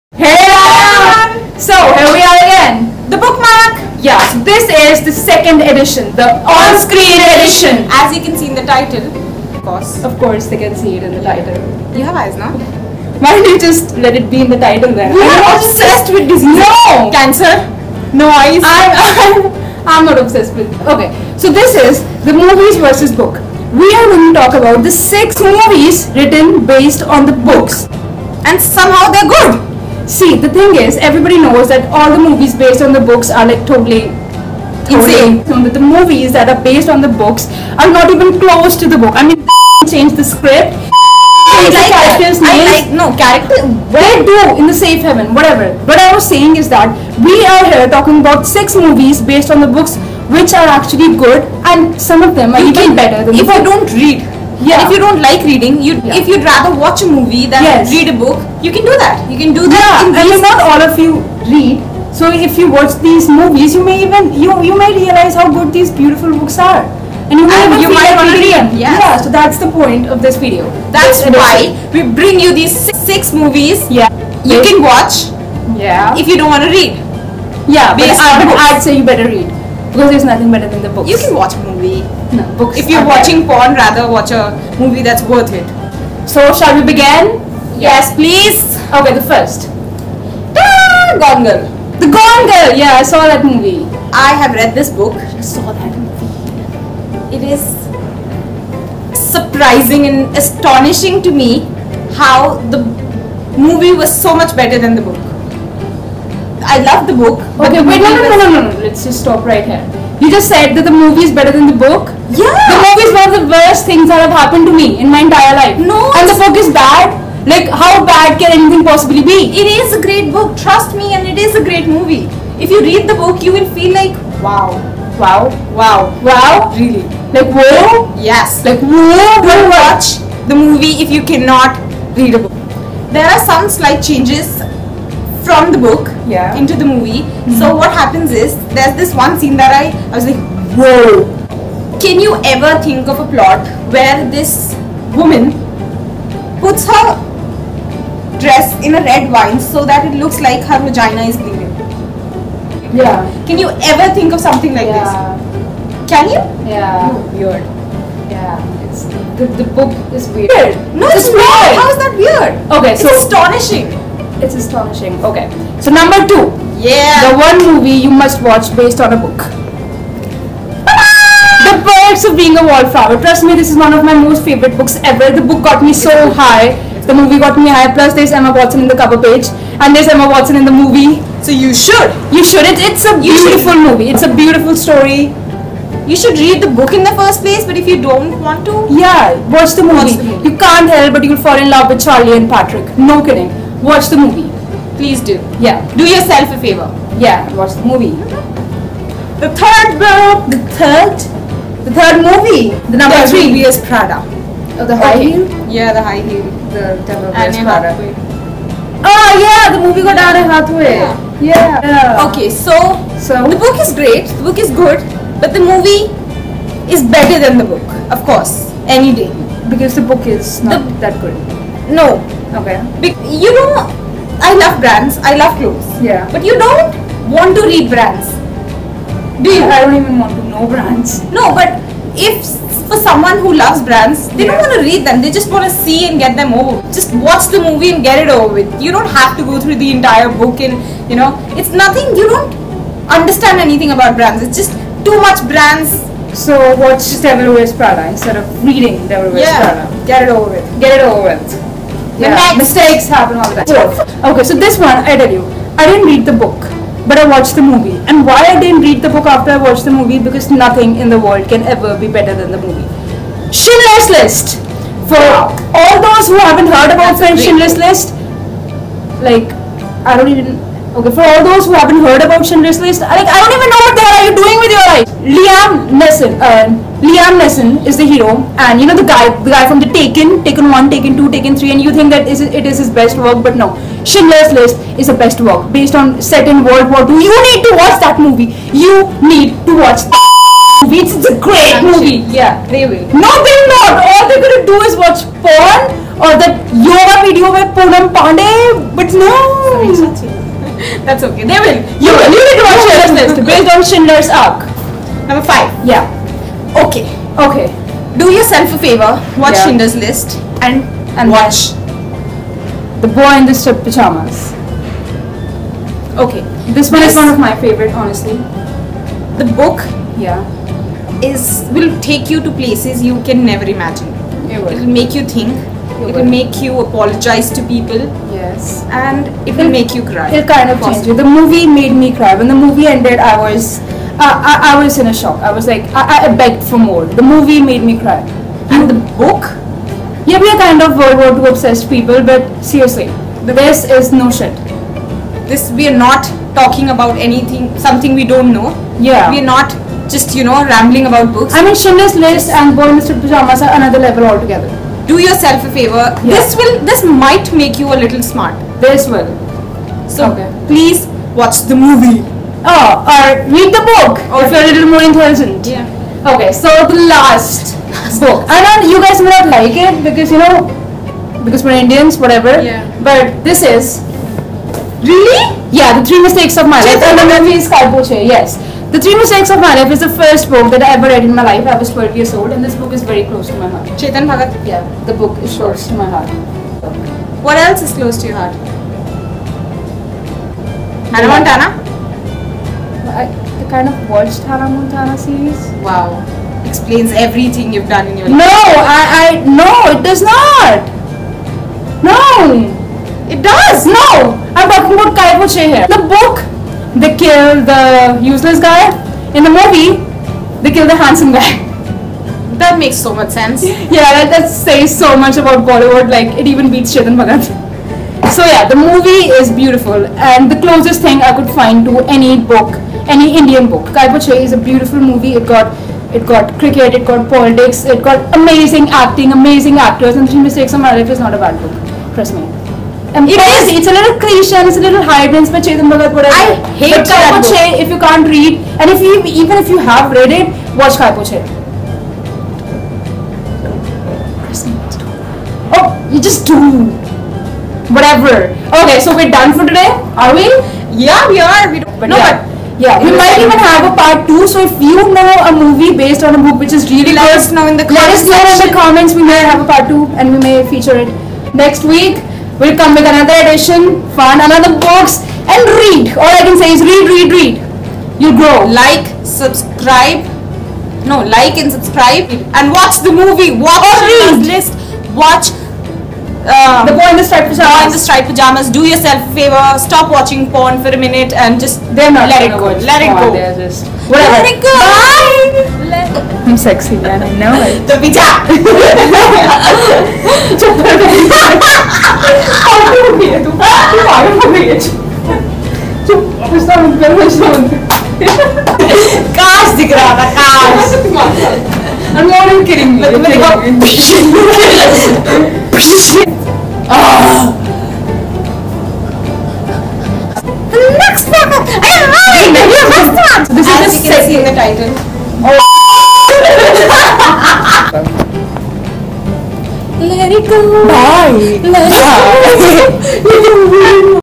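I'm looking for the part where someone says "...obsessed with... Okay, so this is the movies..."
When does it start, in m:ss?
0:20.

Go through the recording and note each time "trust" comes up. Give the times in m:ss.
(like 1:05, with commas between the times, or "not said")
2:00, 2:53, 7:12.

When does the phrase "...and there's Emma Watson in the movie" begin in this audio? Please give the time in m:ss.
2:59.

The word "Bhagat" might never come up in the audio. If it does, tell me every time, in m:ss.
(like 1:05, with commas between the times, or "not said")
6:24, 6:57.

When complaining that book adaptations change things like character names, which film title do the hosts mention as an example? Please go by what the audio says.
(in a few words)
Safe Haven.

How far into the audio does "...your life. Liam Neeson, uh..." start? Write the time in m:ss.
4:34.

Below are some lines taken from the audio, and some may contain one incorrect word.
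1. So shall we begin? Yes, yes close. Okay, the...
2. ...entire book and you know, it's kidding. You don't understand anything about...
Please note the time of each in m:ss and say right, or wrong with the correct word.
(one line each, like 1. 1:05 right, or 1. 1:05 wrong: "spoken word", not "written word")
1. 1:26 wrong: "please", not "close"
2. 3:59 wrong: "nothing", not "kidding".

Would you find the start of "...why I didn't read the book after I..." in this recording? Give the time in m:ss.
4:18.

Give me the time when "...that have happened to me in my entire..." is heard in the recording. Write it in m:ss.
1:54.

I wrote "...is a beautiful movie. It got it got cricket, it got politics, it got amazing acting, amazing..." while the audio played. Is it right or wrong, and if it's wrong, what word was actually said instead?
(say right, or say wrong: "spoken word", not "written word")
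right.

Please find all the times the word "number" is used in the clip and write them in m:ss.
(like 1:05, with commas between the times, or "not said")
2:45, 3:23, 5:05.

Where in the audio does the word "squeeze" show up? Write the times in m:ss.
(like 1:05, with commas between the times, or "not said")
not said.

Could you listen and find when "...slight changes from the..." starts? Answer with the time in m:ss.
2:13.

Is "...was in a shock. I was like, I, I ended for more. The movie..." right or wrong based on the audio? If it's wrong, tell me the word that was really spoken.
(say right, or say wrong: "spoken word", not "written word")
wrong: "begged", not "ended".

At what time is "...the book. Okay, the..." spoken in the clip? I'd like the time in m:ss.
1:47.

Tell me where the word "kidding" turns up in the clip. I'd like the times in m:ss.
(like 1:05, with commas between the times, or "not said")
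3:13, 8:22.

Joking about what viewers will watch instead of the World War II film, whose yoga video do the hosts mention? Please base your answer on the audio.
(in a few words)
Poonam Pandey.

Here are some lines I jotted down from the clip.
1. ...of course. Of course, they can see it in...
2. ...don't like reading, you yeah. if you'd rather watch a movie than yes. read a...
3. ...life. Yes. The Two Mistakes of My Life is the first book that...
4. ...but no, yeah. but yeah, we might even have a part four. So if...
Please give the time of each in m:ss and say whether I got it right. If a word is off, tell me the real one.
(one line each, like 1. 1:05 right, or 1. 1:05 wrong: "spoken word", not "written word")
1. 0:09 right
2. 0:54 right
3. 6:16 wrong: "Three", not "Two"
4. 7:31 wrong: "two", not "four".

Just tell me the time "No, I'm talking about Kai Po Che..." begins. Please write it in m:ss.
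6:43.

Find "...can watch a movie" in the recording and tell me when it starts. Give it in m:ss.
1:21.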